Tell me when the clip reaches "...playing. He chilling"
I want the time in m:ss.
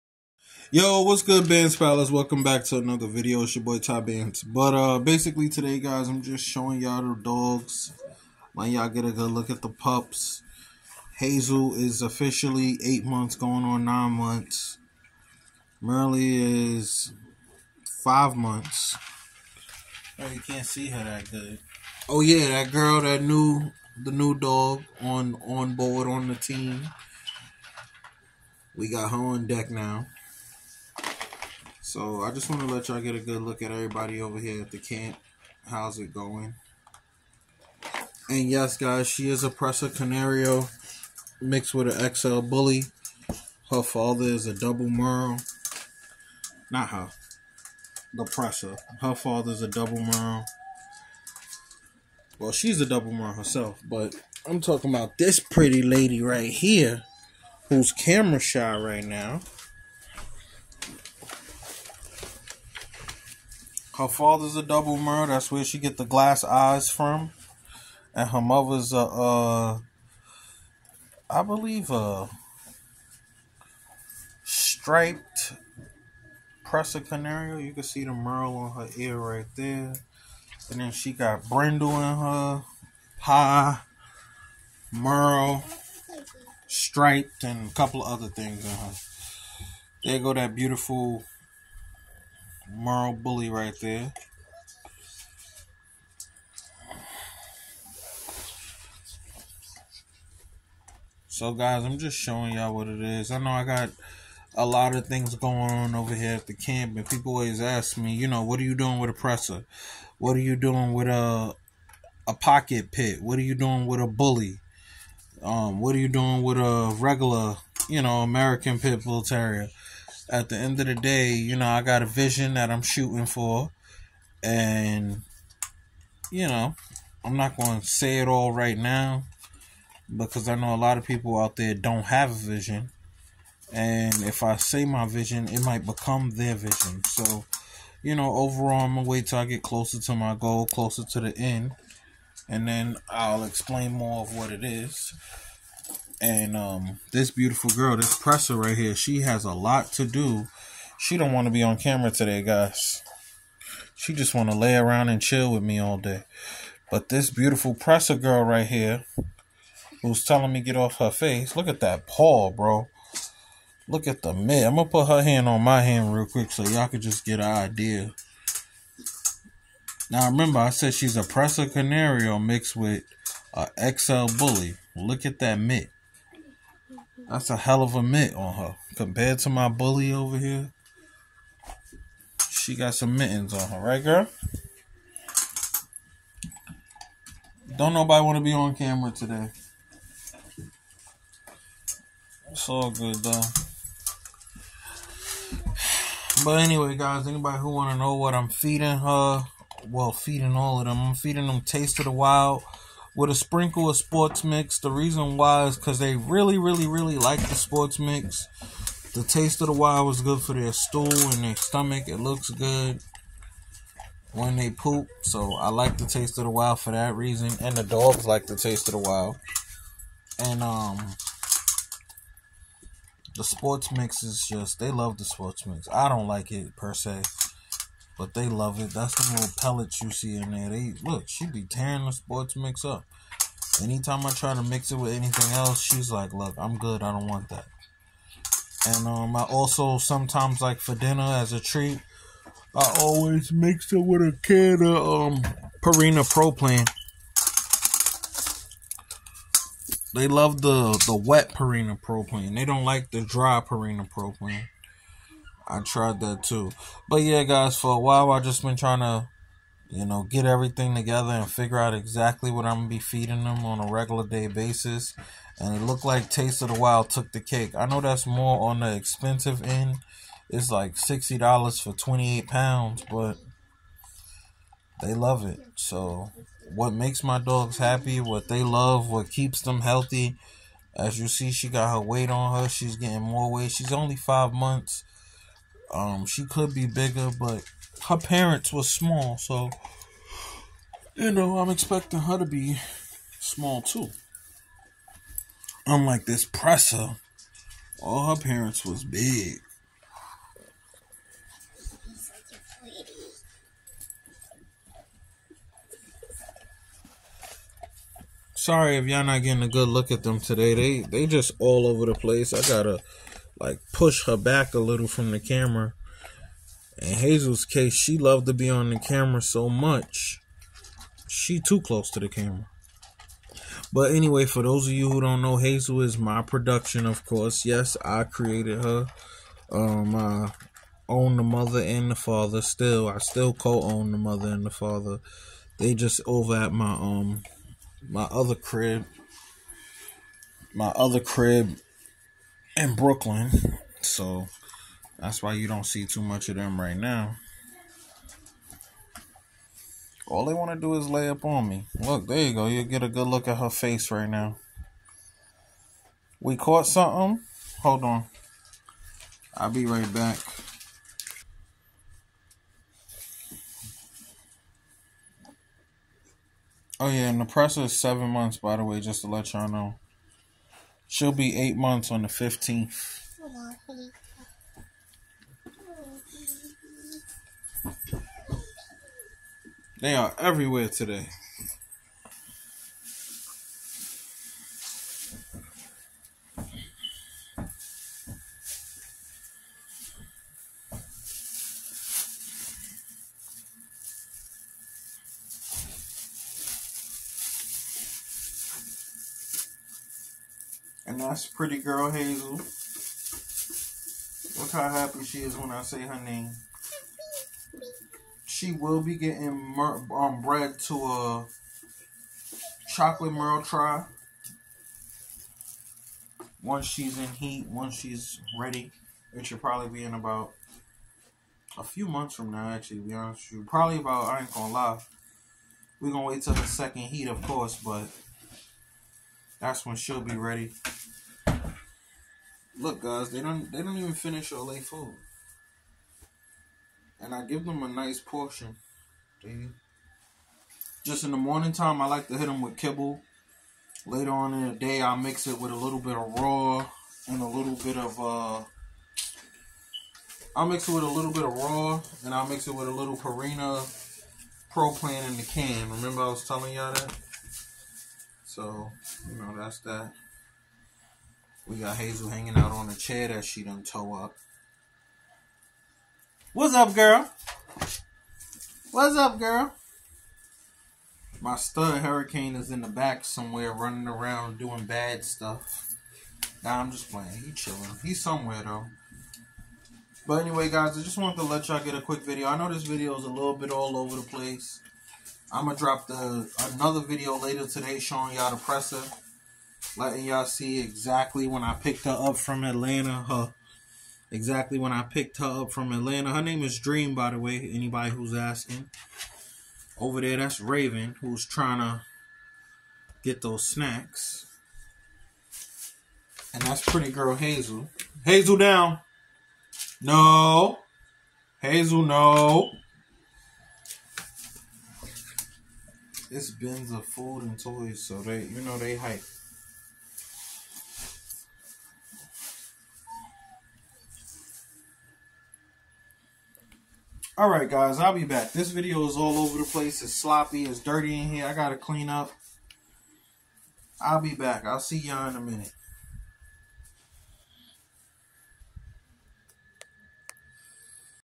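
7:57.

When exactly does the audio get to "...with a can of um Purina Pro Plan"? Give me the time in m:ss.
4:04.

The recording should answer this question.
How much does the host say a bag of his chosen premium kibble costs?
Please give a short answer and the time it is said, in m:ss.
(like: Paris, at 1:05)
$60, at 4:30.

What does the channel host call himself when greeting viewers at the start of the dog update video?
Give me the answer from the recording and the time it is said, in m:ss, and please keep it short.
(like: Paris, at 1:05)
Top Bands, at 0:03.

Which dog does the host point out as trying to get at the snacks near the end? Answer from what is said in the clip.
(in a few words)
Raven.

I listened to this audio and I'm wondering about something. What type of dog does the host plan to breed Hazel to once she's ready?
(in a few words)
chocolate merle tri.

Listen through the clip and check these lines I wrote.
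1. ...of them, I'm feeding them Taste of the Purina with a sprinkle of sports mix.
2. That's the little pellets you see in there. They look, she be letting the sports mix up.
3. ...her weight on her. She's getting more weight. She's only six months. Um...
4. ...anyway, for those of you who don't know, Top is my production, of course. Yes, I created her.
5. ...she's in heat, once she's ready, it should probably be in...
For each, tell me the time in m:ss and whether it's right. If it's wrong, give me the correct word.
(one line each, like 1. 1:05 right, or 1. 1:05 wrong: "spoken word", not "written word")
1. 3:20 wrong: "Wild", not "Purina"
2. 3:48 wrong: "tearing", not "letting"
3. 4:41 wrong: "five", not "six"
4. 5:24 wrong: "Hazel", not "Top"
5. 6:56 right.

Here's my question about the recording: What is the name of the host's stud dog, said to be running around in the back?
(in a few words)
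Hurricane.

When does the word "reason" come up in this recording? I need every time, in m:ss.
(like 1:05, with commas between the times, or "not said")
3:24, 3:37.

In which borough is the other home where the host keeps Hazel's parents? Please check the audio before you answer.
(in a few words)
Brooklyn.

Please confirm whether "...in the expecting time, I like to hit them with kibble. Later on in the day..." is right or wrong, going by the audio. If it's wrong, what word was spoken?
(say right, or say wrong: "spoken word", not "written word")
wrong: "morning", not "expecting".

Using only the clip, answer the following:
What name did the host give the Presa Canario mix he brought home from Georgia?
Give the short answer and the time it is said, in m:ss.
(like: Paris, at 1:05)
Dream, at 8:16.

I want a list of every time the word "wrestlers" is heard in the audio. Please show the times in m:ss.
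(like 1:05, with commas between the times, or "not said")
not said.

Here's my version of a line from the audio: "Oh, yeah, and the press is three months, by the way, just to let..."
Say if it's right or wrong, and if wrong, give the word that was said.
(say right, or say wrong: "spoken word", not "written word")
wrong: "seven", not "three".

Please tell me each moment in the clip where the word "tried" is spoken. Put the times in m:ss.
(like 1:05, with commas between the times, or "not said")
4:15.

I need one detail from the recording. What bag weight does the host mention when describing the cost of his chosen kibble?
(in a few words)
28 pounds.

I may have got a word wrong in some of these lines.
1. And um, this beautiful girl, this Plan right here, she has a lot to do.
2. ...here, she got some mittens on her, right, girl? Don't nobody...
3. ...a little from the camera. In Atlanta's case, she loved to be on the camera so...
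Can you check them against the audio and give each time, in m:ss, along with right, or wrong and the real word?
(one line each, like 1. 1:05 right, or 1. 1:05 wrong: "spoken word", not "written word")
1. 2:26 wrong: "Presa", not "Plan"
2. 3:00 right
3. 5:14 wrong: "Hazel", not "Atlanta".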